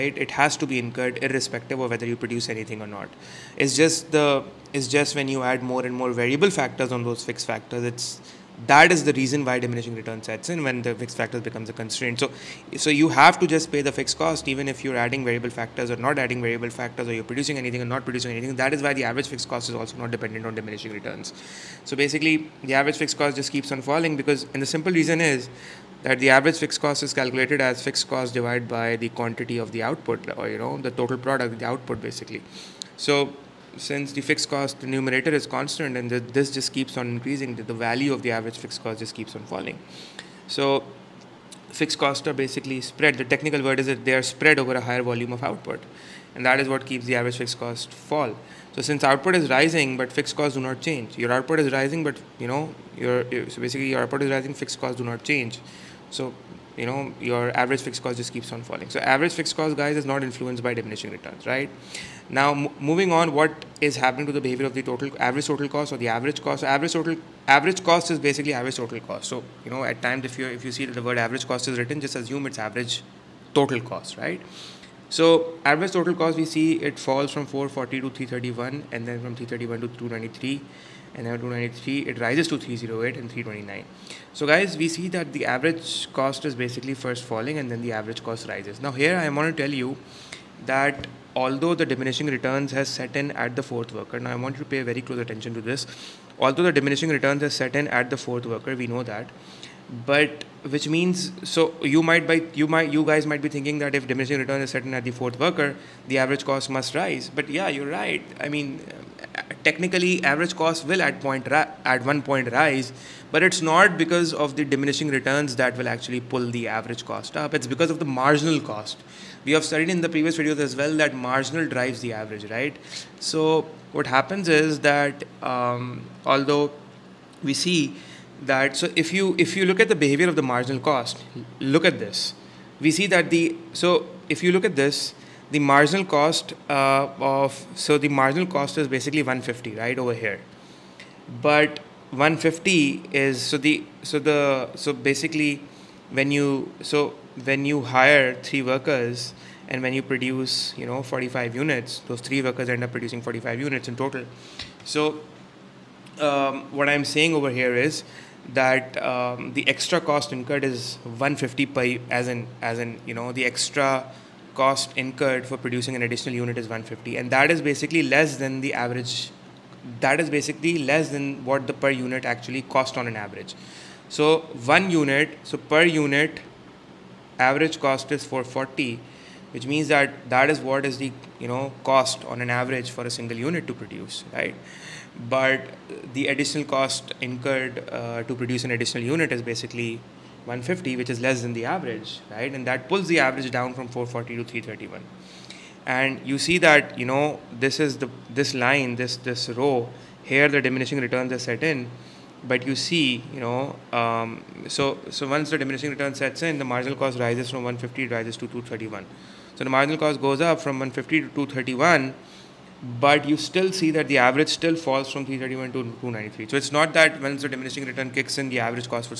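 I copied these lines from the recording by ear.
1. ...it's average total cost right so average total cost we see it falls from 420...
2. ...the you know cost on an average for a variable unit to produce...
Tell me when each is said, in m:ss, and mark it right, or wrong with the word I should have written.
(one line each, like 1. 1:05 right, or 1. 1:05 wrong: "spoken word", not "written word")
1. 1:12 wrong: "440", not "420"
2. 3:00 wrong: "single", not "variable".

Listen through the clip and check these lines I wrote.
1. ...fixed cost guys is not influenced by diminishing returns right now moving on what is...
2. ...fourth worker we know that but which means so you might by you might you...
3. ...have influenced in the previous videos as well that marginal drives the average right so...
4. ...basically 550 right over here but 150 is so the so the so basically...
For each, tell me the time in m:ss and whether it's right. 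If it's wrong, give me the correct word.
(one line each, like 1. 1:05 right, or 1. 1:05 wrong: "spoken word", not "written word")
1. 0:59 right
2. 1:38 right
3. 1:59 wrong: "studied", not "influenced"
4. 2:18 wrong: "150", not "550".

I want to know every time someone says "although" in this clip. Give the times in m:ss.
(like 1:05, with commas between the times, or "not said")
1:31, 1:36, 2:06.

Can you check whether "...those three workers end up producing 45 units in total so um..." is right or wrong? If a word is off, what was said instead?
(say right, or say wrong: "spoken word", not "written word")
right.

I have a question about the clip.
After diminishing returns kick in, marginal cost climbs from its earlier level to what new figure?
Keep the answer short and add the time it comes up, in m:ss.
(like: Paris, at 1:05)
231, at 3:28.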